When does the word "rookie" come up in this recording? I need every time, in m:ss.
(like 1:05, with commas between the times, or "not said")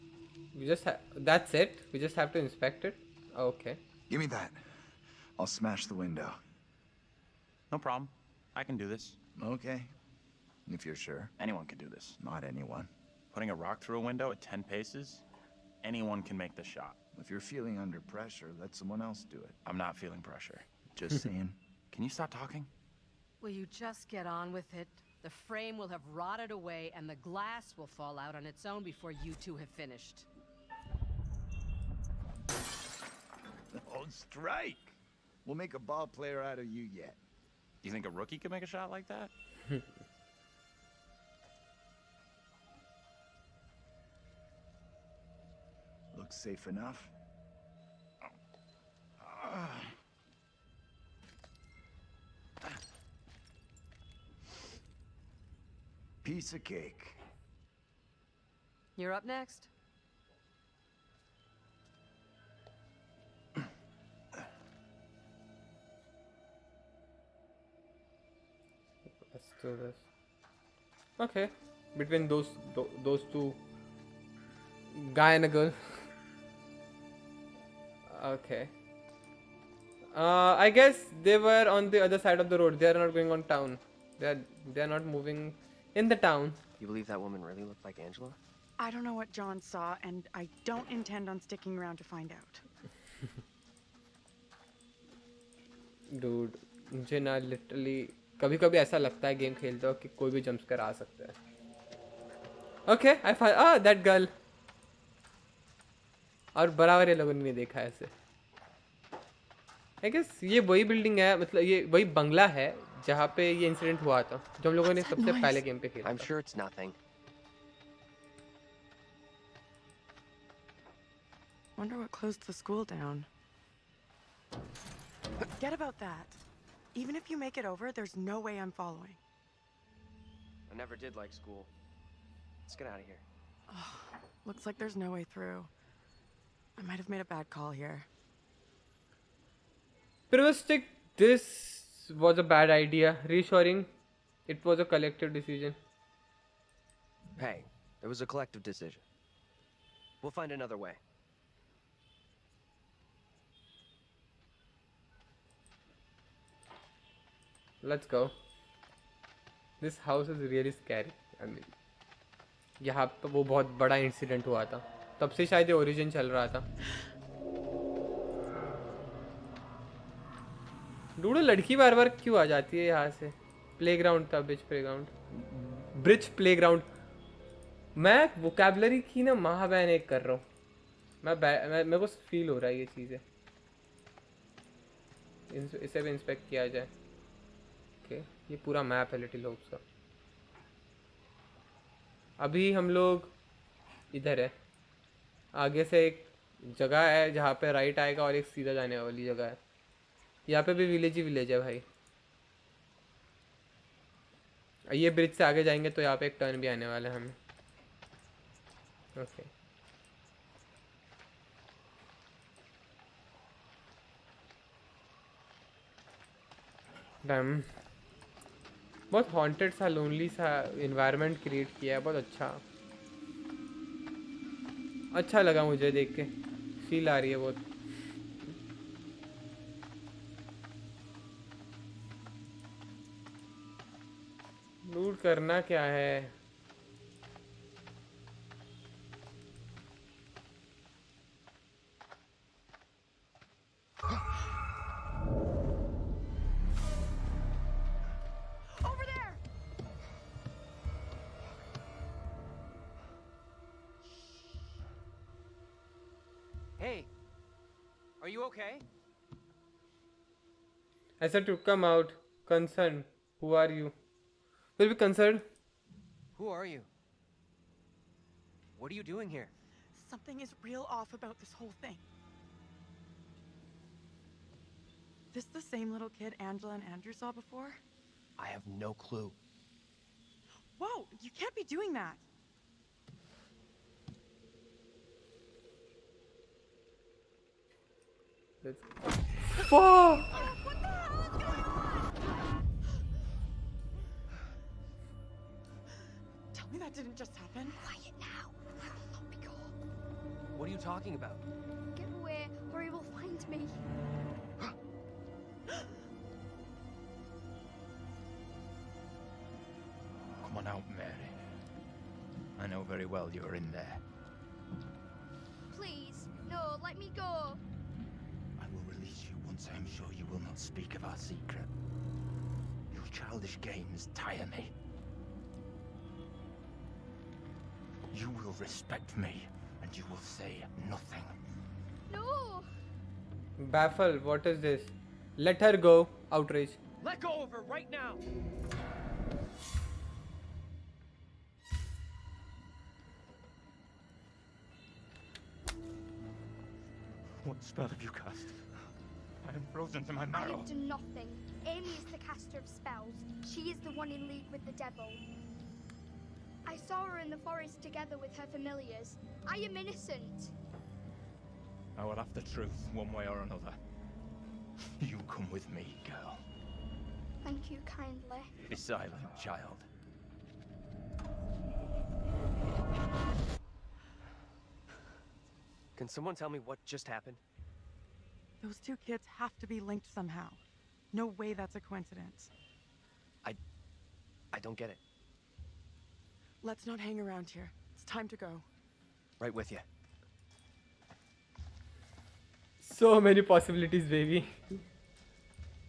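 0:38.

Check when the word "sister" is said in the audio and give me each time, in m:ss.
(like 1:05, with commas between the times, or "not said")
not said.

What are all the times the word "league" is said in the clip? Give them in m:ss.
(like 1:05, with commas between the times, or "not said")
5:54.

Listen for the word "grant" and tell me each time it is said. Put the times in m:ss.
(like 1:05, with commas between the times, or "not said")
not said.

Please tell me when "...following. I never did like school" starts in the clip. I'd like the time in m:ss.
2:08.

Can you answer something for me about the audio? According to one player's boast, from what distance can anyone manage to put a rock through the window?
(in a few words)
10 paces.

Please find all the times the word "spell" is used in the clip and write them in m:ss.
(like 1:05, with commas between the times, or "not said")
5:47, 5:52.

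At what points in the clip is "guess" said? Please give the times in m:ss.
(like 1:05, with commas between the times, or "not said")
1:20.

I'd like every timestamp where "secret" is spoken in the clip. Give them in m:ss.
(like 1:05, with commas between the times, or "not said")
5:21.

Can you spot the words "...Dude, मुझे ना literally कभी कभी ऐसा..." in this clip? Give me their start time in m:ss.
1:36.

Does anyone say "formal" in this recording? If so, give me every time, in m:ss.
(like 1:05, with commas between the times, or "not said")
not said.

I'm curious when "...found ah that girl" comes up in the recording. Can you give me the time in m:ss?
1:43.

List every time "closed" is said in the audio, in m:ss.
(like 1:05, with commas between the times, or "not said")
2:02.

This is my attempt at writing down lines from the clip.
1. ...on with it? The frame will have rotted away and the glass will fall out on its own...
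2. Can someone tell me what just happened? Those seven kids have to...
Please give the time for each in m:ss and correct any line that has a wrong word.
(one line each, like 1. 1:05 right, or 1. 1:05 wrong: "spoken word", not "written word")
1. 0:24 right
2. 6:15 wrong: "two", not "seven".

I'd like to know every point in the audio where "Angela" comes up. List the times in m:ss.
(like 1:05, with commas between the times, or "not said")
1:28, 4:36.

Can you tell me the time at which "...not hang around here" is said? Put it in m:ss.
6:26.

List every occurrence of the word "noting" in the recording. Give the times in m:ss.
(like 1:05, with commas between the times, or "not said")
not said.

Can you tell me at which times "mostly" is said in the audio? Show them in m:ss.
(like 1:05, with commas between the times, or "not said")
not said.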